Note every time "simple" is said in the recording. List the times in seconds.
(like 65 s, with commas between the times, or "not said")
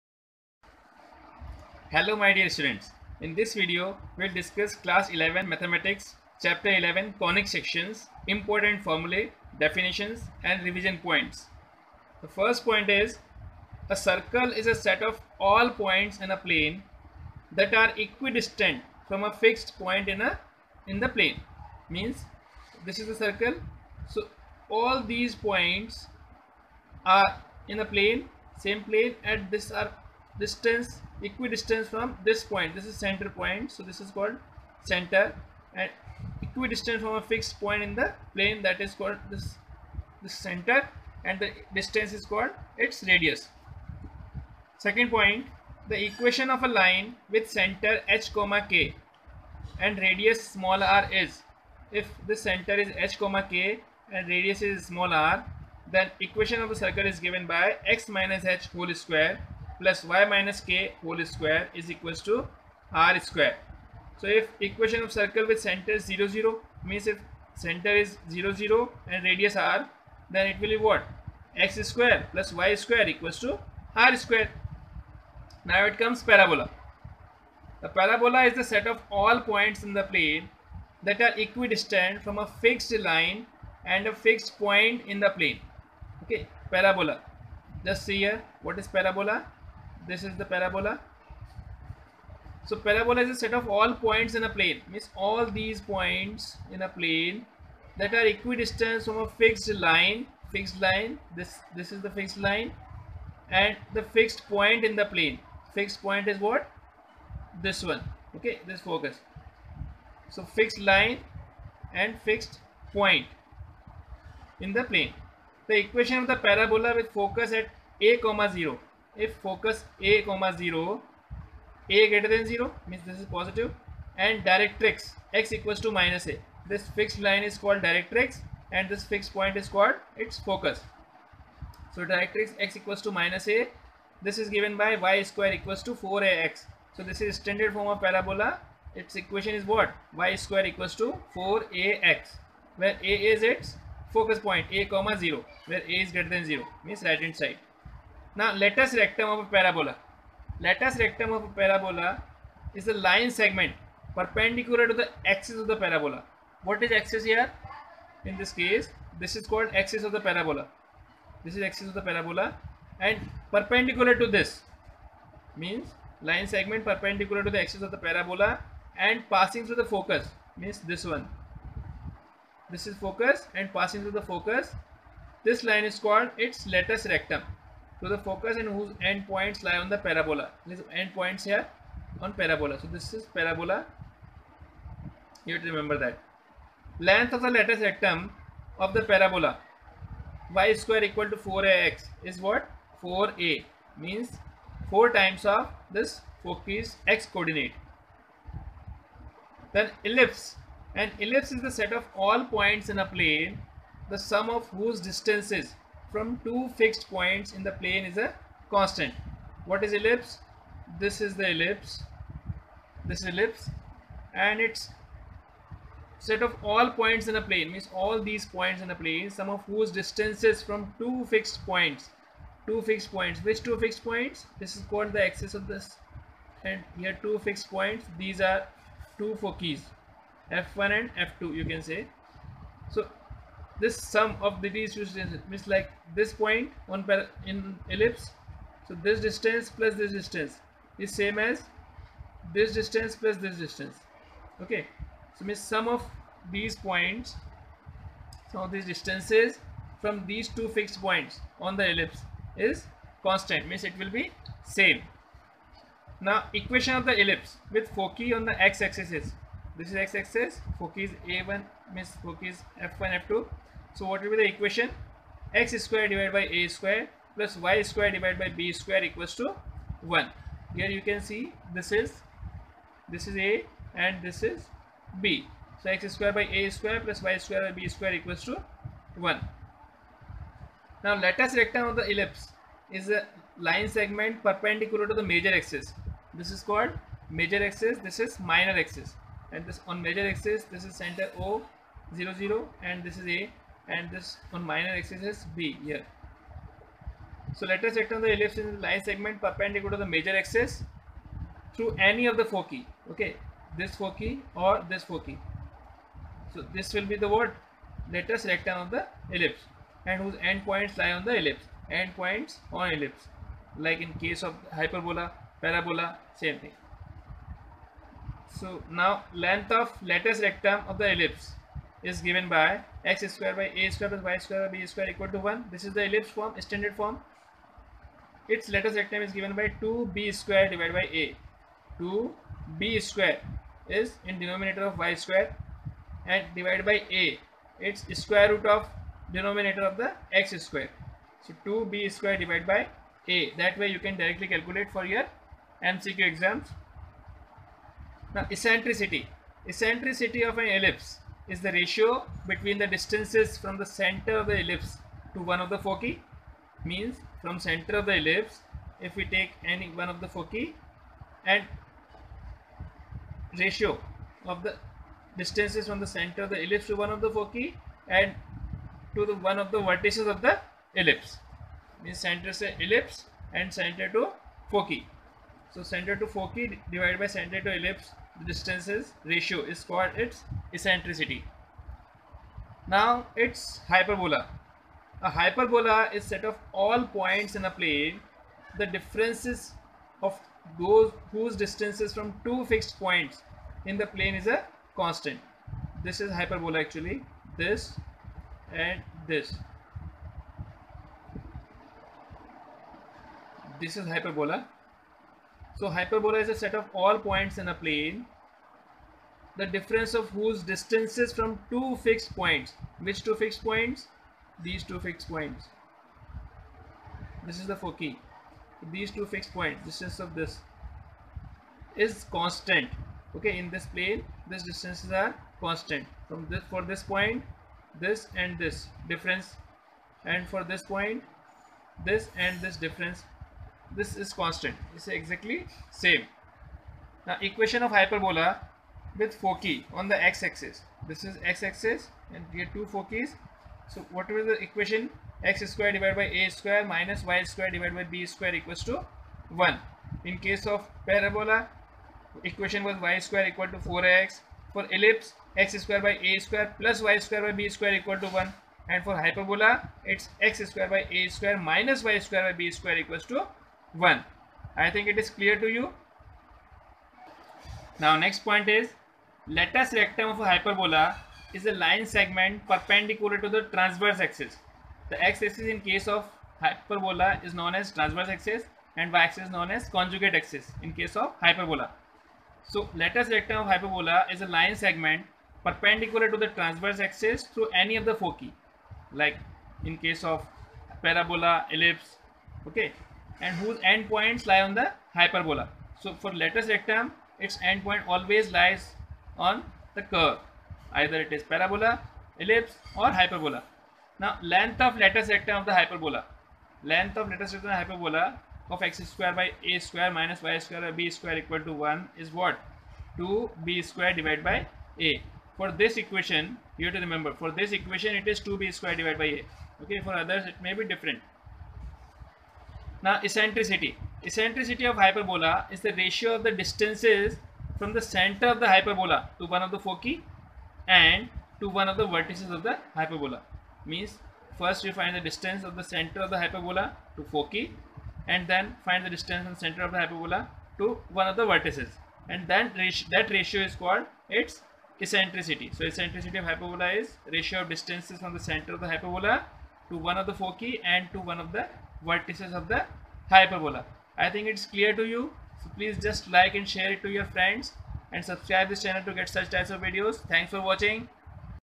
not said.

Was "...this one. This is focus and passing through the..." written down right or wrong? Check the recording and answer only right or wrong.
right.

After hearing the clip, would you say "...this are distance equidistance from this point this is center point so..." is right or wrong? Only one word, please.
right.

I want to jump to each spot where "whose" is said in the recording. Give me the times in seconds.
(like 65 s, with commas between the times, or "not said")
178 s, 204 s, 219 s, 310 s, 391 s, 410 s, 493 s.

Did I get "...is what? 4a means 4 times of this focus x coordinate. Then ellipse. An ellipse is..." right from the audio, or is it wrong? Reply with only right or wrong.
right.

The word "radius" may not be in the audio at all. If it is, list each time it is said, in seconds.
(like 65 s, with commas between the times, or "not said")
43 s, 49 s, 54 s, 69 s.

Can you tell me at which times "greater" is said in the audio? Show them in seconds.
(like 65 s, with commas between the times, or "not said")
122 s, 146 s.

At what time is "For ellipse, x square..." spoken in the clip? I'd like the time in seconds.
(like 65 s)
454 s.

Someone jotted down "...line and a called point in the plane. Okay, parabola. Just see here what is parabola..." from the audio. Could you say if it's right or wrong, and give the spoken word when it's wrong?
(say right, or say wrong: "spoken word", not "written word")
wrong: "fixed", not "called".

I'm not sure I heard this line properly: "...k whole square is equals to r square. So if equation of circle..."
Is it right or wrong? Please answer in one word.
right.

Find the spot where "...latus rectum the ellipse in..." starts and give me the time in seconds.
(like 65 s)
297 s.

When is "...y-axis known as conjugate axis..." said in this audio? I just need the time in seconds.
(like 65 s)
479 s.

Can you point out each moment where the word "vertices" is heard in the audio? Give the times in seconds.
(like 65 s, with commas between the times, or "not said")
369 s, 532 s, 541 s, 552 s.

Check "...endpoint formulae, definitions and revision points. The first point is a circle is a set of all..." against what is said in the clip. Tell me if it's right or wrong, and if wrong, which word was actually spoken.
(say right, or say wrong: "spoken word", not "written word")
wrong: "important", not "endpoint".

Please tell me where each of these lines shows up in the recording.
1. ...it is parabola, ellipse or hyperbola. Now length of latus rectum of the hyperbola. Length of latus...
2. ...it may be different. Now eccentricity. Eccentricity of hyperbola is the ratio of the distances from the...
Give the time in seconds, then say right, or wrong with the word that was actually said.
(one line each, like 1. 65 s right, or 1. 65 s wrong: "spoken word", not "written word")
1. 501 s right
2. 520 s right.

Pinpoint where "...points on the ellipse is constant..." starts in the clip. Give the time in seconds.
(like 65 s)
251 s.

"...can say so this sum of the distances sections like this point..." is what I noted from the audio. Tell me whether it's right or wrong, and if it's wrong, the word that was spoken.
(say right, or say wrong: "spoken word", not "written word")
wrong: "means", not "sections".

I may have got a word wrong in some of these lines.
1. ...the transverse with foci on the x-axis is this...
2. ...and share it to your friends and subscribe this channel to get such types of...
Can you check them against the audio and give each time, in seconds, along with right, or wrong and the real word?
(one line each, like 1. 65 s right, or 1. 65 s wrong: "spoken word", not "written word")
1. 257 s wrong: "ellipse", not "transverse"
2. 556 s right.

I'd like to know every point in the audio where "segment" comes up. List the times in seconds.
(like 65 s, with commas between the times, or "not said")
153 s, 166 s, 283 s, 299 s, 472 s, 484 s.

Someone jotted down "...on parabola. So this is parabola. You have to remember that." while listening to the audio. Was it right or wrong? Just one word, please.
right.